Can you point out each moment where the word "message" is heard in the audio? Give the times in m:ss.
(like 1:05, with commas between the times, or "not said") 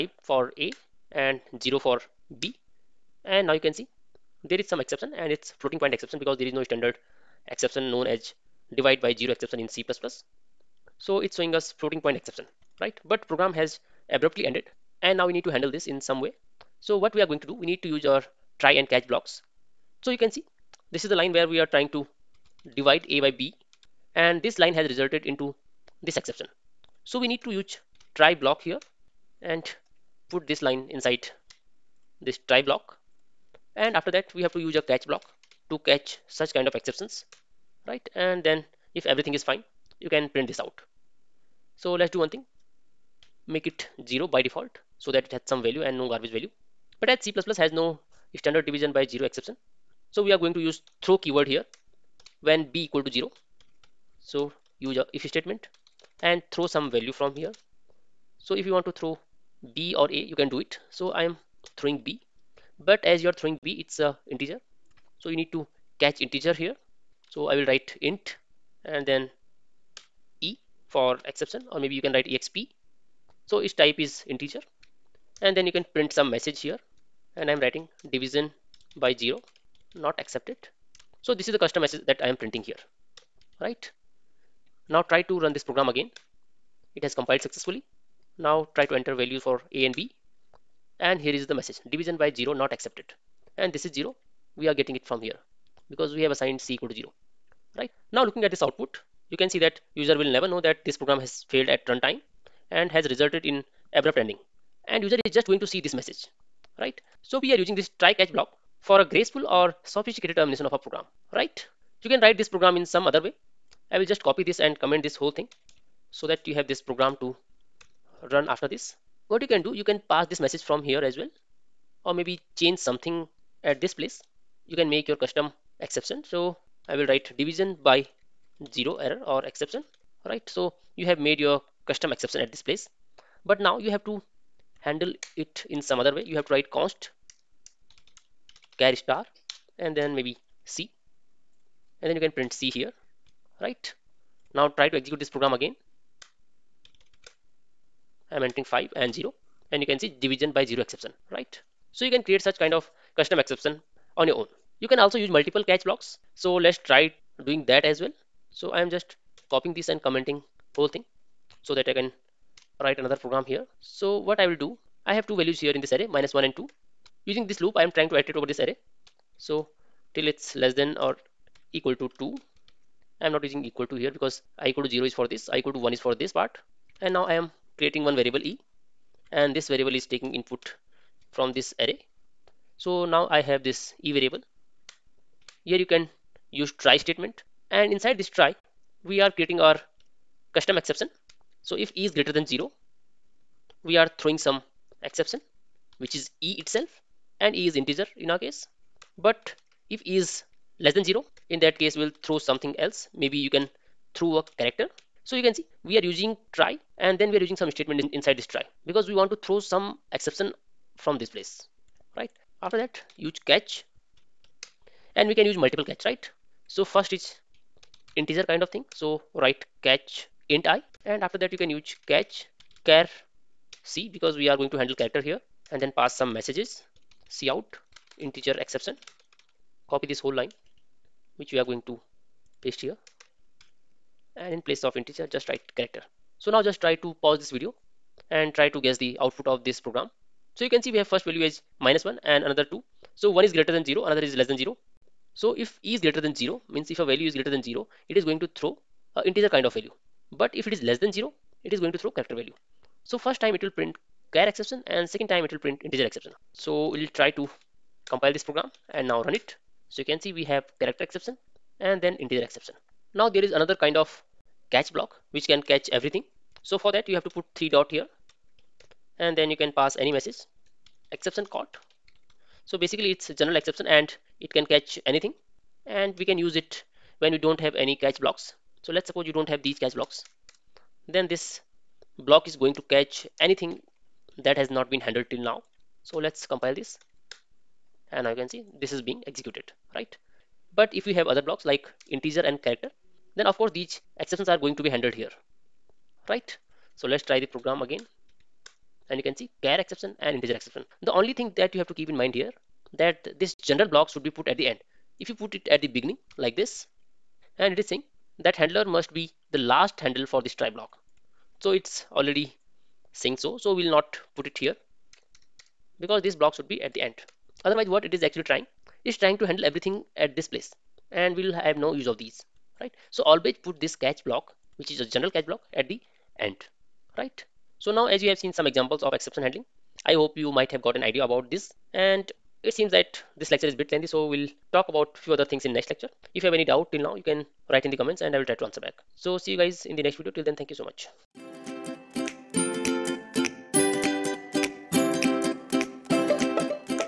1:16, 1:21, 1:31, 1:45, 2:00, 3:46, 4:30.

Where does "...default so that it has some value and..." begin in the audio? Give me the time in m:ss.
0:44.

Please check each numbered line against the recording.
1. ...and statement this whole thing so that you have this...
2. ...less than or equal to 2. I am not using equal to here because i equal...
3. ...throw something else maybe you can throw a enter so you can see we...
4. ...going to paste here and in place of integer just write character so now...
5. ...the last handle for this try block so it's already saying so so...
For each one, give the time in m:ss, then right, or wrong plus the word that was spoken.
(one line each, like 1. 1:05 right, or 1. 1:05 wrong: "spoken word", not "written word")
1. 1:54 wrong: "comment", not "statement"
2. 2:50 right
3. 3:22 wrong: "character", not "enter"
4. 3:51 right
5. 5:09 right.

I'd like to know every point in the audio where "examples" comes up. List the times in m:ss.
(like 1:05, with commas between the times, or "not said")
5:28.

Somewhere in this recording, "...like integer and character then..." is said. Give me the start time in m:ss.
4:51.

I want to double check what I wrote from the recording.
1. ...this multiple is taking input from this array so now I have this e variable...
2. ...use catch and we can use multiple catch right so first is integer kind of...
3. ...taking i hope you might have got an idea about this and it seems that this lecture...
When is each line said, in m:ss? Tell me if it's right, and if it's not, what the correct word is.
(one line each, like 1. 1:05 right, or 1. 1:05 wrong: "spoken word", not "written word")
1. 2:59 wrong: "variable", not "multiple"
2. 3:33 right
3. 5:29 wrong: "handling", not "taking".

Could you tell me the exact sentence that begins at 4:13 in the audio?
So first time it will print char exception and second time it will print integer exception.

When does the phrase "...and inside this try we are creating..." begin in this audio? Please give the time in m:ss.
3:07.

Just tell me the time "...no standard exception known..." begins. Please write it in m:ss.
0:06.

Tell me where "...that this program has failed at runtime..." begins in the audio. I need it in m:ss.
1:40.